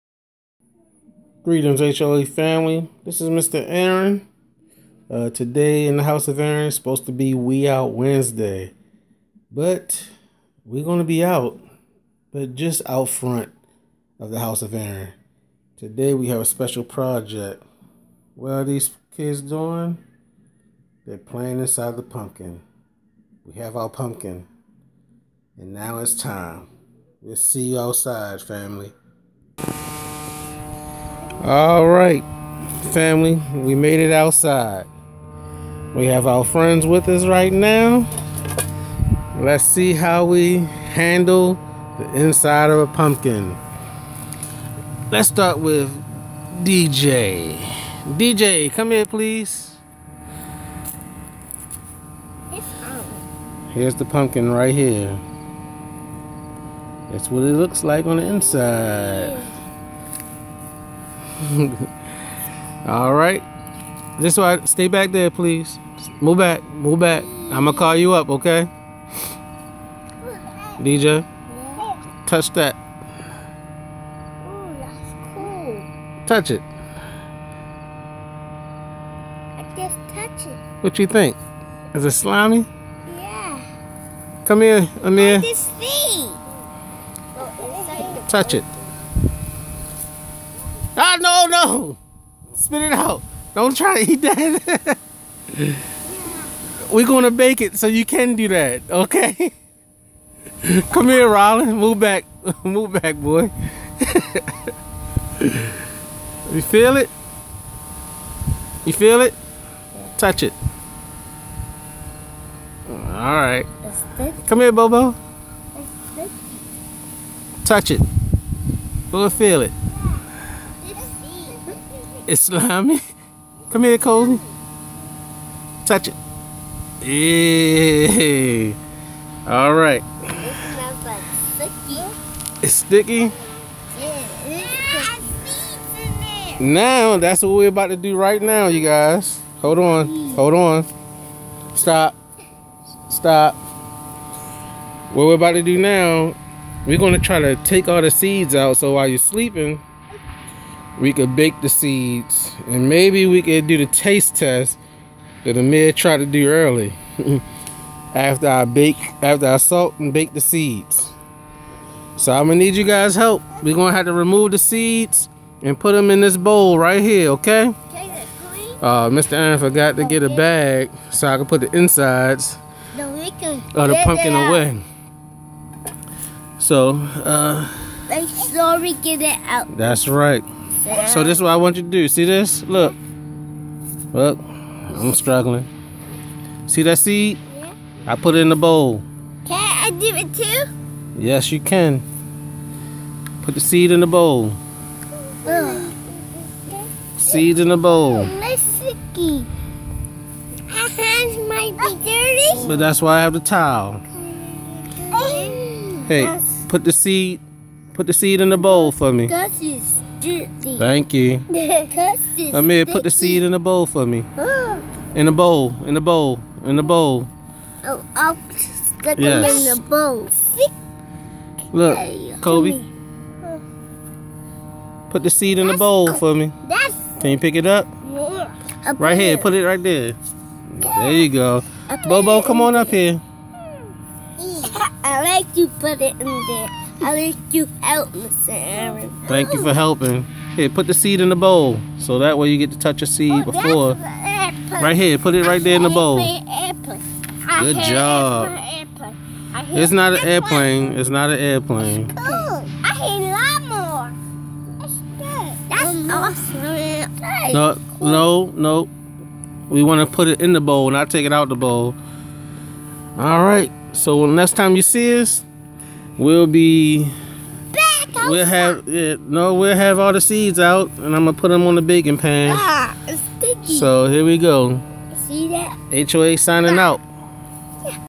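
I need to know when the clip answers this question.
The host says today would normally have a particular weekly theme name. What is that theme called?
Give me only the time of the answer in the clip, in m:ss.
0:07.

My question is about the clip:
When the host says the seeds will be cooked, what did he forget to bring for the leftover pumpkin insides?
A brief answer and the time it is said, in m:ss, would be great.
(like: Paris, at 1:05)
a bag, at 2:49.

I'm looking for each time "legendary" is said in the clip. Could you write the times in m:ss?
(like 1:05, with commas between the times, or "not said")
not said.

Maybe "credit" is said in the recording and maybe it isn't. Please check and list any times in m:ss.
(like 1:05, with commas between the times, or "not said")
not said.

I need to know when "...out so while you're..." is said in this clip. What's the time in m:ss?
2:28.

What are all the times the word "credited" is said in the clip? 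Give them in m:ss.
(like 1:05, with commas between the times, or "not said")
not said.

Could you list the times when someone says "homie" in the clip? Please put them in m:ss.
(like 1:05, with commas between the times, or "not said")
not said.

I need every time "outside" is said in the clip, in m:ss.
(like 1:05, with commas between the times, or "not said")
0:27, 0:34.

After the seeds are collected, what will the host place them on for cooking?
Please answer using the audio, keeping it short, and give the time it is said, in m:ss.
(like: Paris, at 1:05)
the baking pan, at 4:31.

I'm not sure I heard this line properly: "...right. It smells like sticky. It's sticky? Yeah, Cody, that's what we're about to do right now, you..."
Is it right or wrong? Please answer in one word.
wrong.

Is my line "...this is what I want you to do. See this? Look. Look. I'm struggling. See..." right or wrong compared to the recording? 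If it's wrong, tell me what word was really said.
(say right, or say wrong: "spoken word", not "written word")
right.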